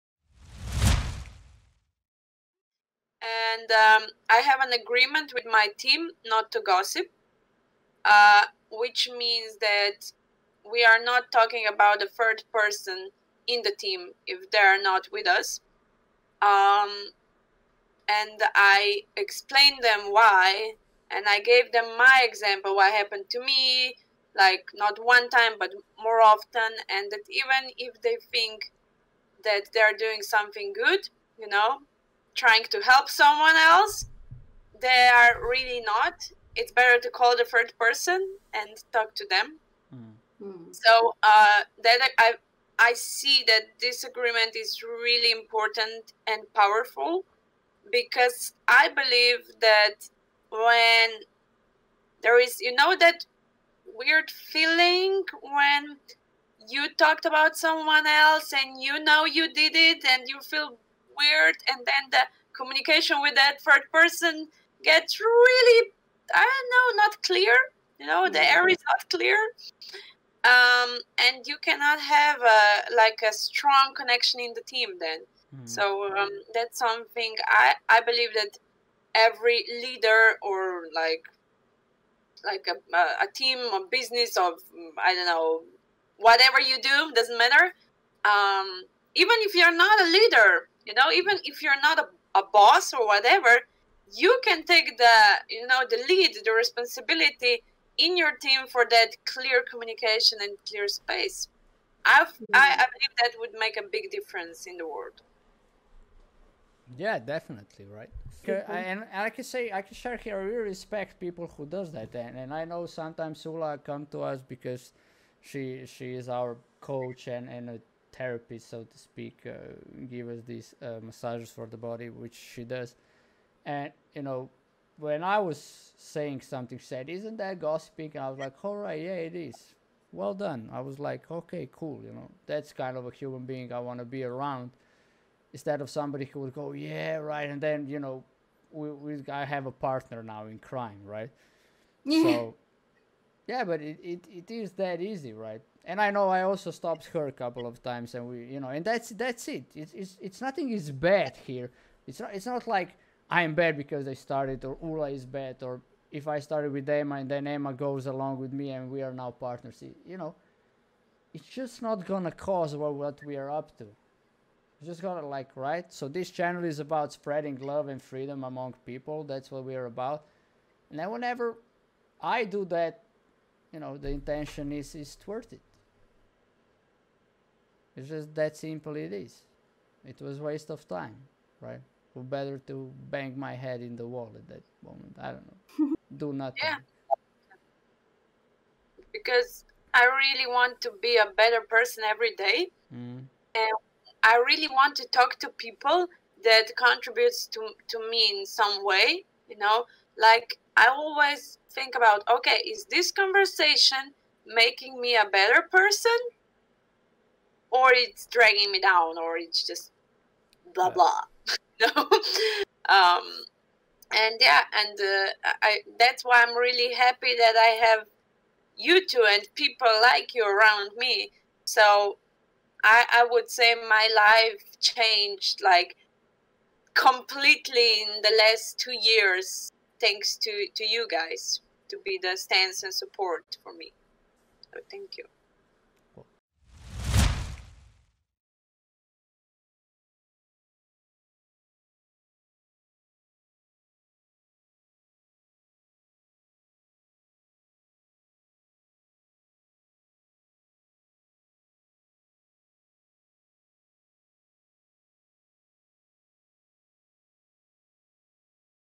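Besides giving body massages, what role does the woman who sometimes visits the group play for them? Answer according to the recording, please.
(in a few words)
coach.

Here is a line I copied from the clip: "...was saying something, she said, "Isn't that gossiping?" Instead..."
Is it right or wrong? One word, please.
wrong.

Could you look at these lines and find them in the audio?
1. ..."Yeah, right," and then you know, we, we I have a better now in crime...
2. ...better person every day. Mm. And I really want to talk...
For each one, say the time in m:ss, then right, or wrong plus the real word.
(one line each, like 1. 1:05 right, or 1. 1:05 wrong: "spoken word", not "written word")
1. 2:16 wrong: "partner", not "better"
2. 3:11 right.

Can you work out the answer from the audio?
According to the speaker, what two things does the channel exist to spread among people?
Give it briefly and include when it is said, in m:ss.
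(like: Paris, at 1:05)
love and freedom, at 2:47.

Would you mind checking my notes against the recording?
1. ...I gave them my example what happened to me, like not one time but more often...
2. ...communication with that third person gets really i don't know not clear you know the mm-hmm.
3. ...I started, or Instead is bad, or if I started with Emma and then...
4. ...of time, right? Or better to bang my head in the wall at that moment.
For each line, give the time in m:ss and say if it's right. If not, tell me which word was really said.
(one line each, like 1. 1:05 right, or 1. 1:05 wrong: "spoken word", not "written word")
1. 0:21 right
2. 1:02 right
3. 2:34 wrong: "Ula", not "Instead"
4. 3:00 right.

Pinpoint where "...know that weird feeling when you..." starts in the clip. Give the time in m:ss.
0:52.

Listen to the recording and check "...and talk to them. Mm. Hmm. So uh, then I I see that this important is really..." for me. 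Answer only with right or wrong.
wrong.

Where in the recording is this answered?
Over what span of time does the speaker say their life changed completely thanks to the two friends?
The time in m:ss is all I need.
3:48.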